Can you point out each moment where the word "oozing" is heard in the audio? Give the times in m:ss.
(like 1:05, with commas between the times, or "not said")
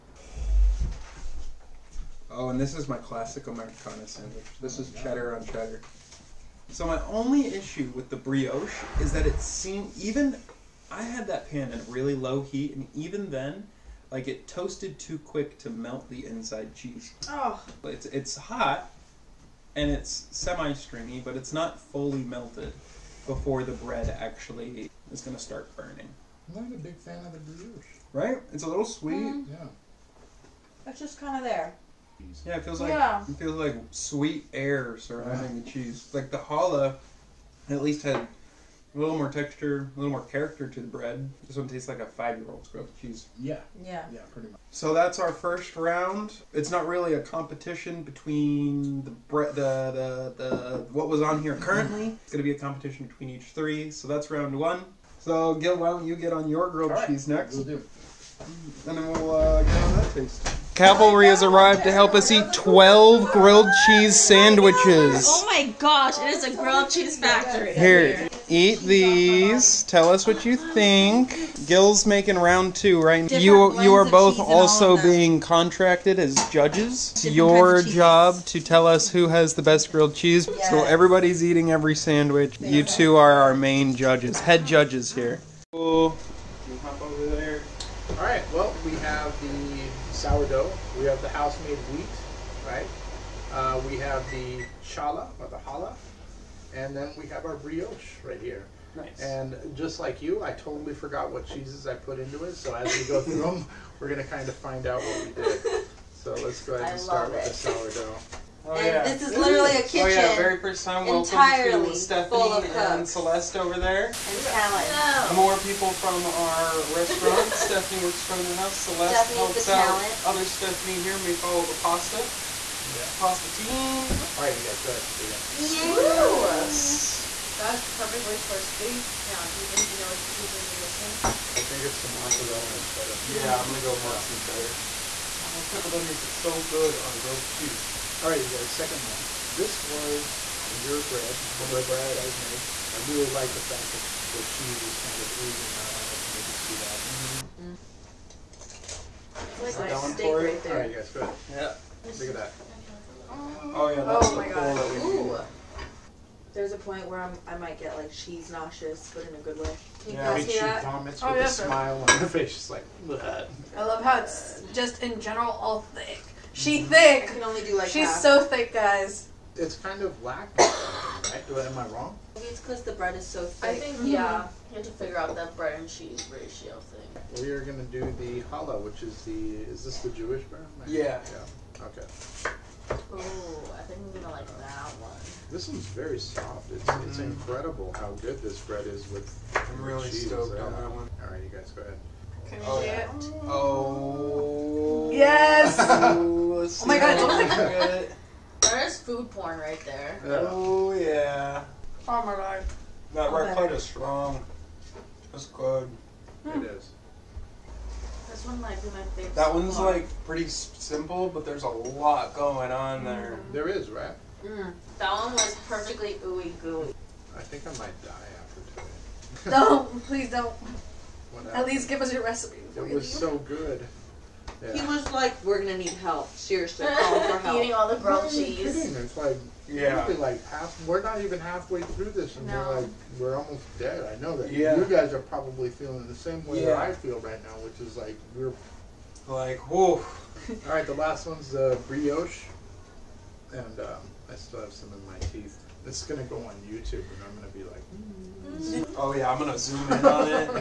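2:25.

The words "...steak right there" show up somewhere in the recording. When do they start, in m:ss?
2:30.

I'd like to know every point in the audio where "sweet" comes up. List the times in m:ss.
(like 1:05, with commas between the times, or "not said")
0:28, 0:33.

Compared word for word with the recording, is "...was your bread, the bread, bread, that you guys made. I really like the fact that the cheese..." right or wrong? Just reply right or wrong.
right.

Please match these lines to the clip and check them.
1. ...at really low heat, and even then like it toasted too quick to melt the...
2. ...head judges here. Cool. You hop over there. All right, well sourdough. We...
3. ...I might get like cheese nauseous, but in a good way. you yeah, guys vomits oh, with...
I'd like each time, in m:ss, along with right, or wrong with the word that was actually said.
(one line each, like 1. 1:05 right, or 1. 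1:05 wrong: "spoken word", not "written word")
1. 0:11 right
2. 1:24 right
3. 2:37 right.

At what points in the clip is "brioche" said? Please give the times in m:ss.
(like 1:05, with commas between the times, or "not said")
0:08, 0:27, 1:37, 4:01.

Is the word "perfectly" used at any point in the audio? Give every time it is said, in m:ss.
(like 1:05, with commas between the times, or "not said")
2:07, 3:35.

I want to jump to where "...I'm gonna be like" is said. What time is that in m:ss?
4:07.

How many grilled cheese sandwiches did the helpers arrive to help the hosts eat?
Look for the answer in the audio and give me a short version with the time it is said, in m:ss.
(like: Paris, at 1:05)
12, at 1:02.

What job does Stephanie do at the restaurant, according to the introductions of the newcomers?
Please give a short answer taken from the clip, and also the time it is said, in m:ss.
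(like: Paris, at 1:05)
Front of the house, at 1:58.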